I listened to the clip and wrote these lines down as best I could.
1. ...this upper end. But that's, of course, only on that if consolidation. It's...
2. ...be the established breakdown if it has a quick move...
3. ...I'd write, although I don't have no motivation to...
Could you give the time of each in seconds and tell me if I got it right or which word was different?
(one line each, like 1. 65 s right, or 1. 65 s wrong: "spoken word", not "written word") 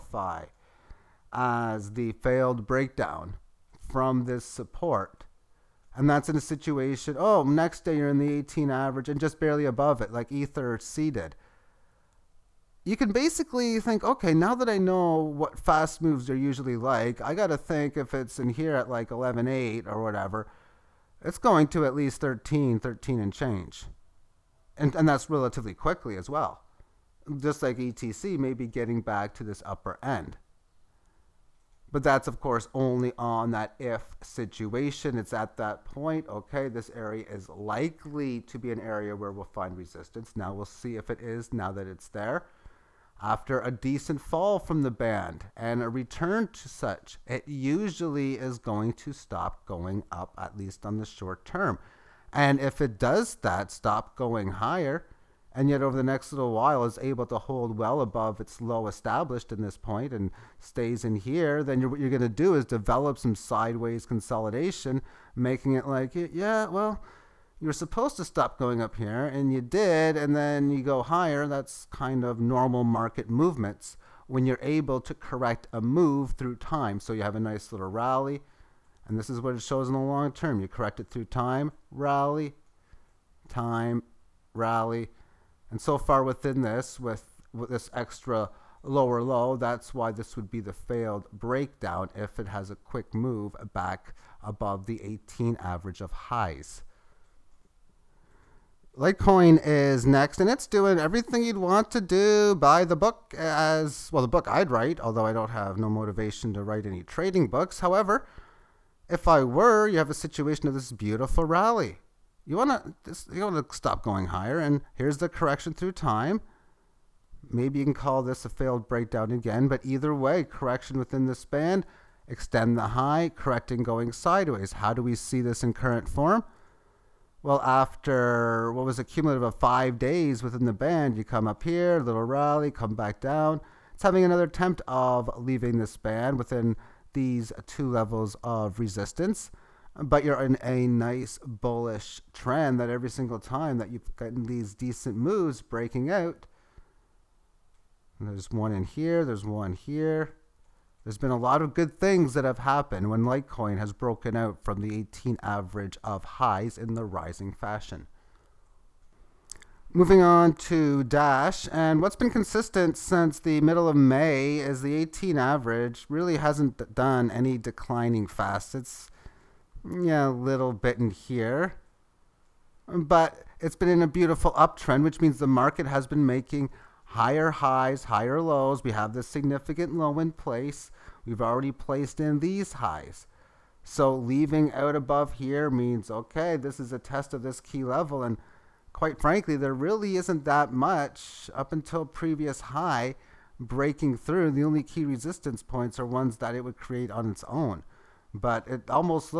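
1. 29 s wrong: "situation", not "consolidation"
2. 90 s wrong: "failed", not "established"
3. 104 s right.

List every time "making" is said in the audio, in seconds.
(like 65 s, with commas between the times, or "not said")
65 s, 176 s.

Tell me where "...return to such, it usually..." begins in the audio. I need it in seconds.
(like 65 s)
45 s.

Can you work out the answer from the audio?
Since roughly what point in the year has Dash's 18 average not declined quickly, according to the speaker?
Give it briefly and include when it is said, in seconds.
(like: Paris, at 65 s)
middle of May, at 163 s.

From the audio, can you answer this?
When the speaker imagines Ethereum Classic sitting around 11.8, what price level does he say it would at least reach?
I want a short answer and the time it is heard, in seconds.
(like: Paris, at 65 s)
13, at 22 s.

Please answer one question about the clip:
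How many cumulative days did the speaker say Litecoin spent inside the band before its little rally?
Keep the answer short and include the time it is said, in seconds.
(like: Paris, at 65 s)
5, at 129 s.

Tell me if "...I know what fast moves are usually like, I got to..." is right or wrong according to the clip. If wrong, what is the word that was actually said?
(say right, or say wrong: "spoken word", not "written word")
right.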